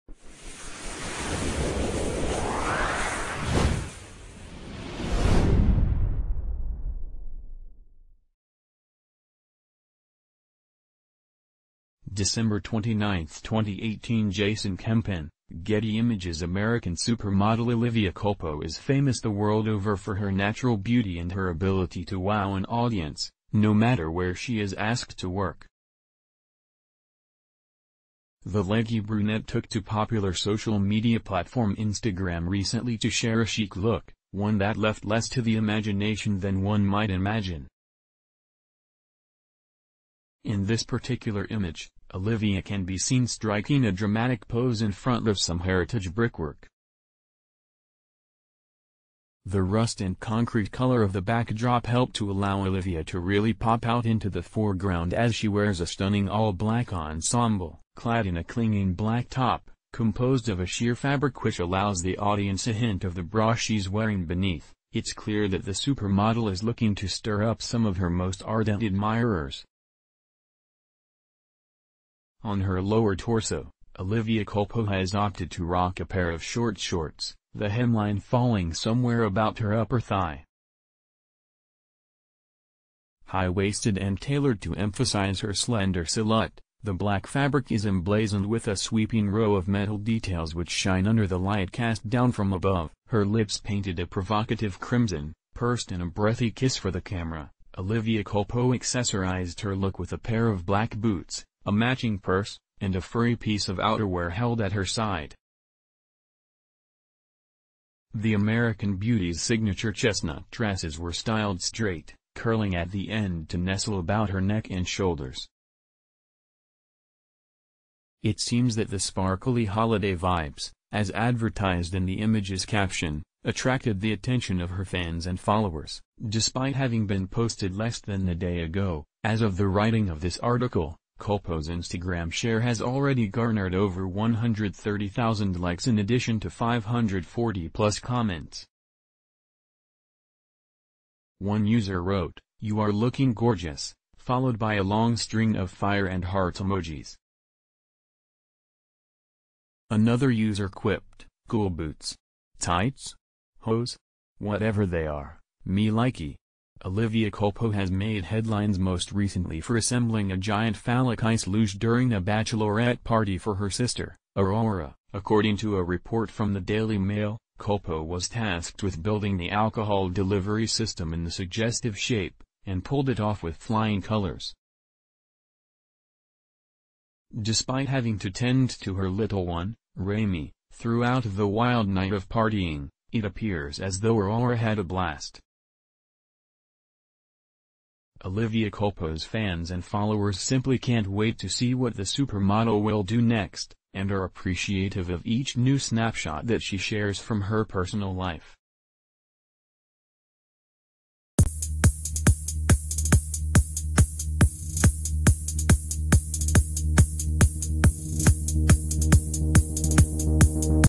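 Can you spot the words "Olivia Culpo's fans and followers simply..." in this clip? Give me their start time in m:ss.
3:08.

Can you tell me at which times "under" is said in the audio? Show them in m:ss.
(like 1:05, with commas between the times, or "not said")
1:31.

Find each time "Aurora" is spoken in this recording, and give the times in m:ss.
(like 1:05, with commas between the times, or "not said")
2:44, 3:04.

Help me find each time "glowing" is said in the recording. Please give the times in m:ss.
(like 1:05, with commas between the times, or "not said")
not said.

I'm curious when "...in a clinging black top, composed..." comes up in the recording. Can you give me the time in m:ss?
0:58.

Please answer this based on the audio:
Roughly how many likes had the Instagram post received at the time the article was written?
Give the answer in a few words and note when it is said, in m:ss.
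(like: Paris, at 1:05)
130,000, at 2:14.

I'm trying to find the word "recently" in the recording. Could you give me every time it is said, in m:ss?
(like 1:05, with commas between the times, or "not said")
0:32, 2:39.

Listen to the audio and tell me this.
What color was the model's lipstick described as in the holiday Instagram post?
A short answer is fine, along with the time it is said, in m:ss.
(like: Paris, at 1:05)
Crimson, at 1:34.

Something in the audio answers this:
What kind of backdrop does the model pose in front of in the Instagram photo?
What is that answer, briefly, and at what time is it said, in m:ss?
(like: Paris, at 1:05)
Heritage brickwork, at 0:45.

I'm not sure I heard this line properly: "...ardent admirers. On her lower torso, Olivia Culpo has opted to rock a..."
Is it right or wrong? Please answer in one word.
right.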